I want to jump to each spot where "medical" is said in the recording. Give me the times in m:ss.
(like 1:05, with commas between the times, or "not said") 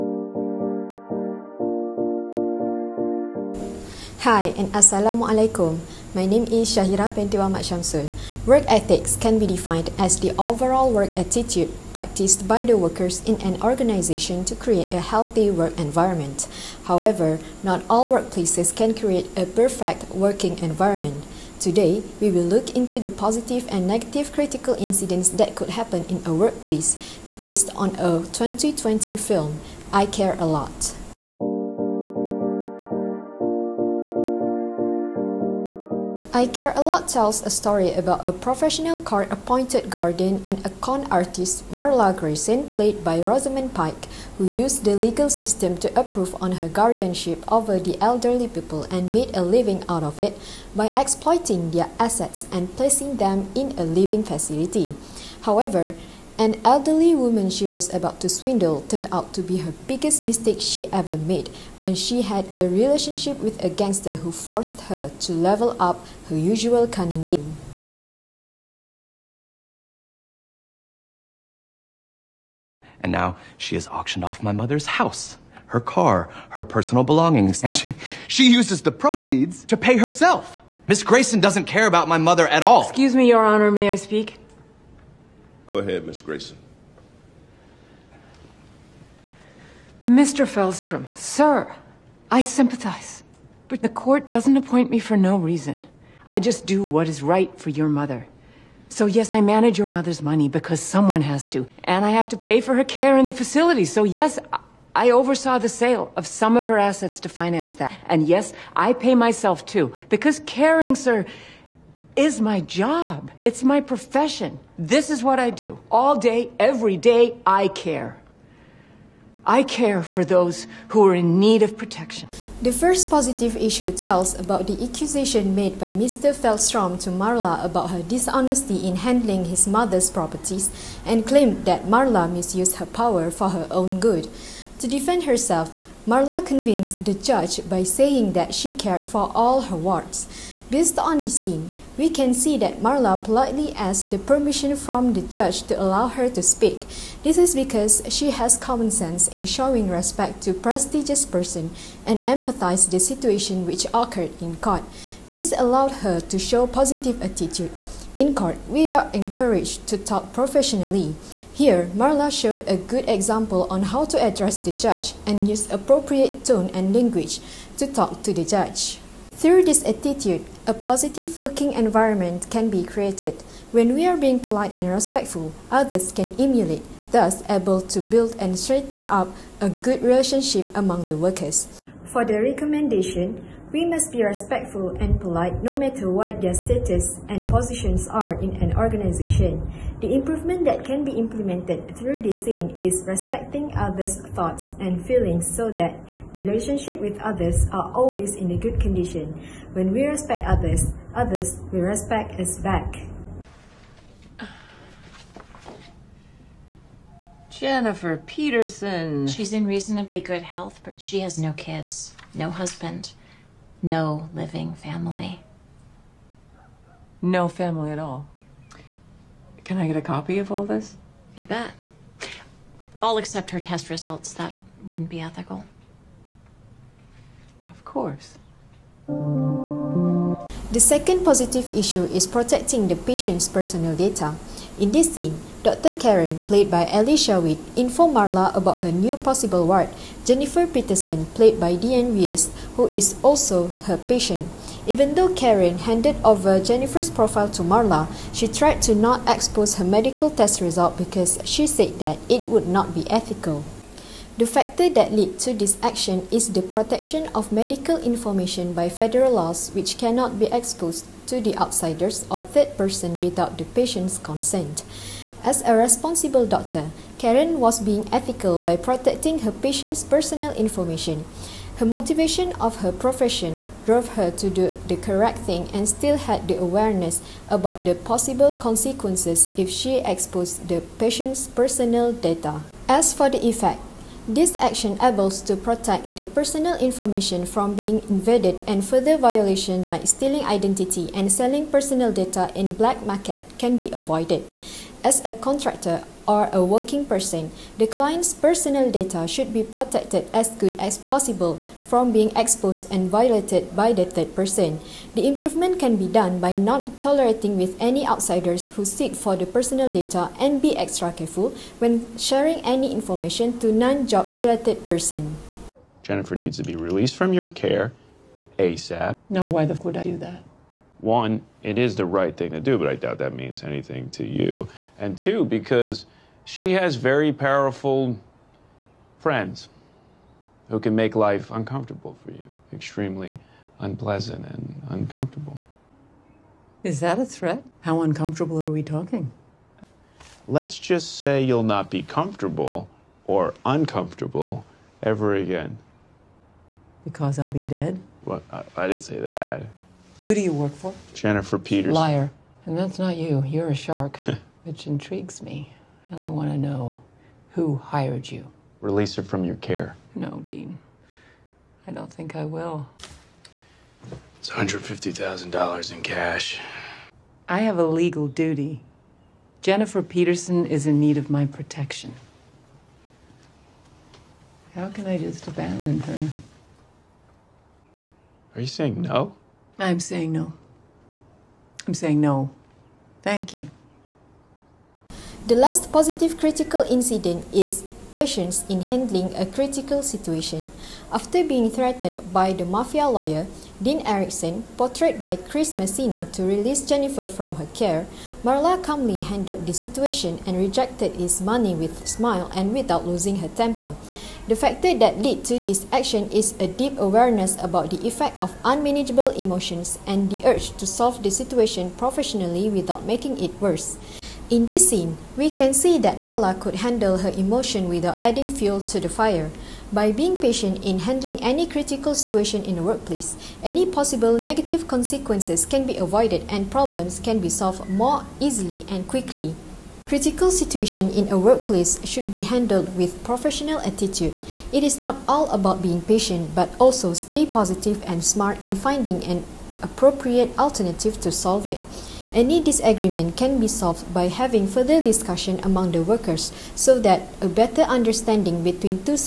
4:09, 4:17.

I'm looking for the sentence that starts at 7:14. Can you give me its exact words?
It is not all about being patient, but also stay positive and smart in finding an appropriate alternative to solve it.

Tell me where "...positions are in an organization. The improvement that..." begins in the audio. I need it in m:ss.
3:07.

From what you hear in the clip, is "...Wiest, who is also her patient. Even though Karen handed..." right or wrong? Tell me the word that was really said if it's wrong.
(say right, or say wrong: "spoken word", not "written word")
right.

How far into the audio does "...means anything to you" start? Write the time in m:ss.
5:23.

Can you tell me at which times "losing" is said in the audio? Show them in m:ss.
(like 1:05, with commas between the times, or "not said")
6:43.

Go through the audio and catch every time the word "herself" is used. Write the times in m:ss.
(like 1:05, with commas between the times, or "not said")
1:19, 2:15.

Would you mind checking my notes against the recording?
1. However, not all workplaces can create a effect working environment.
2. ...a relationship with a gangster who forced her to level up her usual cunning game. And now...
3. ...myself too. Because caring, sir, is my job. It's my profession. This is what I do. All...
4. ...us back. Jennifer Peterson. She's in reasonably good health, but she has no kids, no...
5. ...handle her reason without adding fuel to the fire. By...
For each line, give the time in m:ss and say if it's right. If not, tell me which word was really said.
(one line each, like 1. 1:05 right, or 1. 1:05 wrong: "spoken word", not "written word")
1. 0:16 wrong: "perfect", not "effect"
2. 1:02 right
3. 1:49 right
4. 3:22 right
5. 6:56 wrong: "emotion", not "reason".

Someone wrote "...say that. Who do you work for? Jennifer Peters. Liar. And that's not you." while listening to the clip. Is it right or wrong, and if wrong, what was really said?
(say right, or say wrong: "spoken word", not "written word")
right.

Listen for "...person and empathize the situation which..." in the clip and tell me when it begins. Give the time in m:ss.
2:31.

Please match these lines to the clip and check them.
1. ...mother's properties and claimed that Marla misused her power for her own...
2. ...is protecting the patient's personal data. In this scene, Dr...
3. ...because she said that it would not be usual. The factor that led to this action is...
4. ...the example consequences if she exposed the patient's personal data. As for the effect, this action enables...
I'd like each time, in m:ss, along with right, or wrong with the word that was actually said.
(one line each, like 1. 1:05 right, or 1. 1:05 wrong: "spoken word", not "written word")
1. 2:09 right
2. 3:52 right
3. 4:10 wrong: "ethical", not "usual"
4. 4:37 wrong: "possible", not "example".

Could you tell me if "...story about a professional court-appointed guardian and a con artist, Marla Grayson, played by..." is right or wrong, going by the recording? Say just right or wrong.
right.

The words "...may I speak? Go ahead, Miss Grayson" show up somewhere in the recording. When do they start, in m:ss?
1:23.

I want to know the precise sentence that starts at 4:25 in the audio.
As a responsible doctor, Karen was being ethical by protecting her patient's personal information.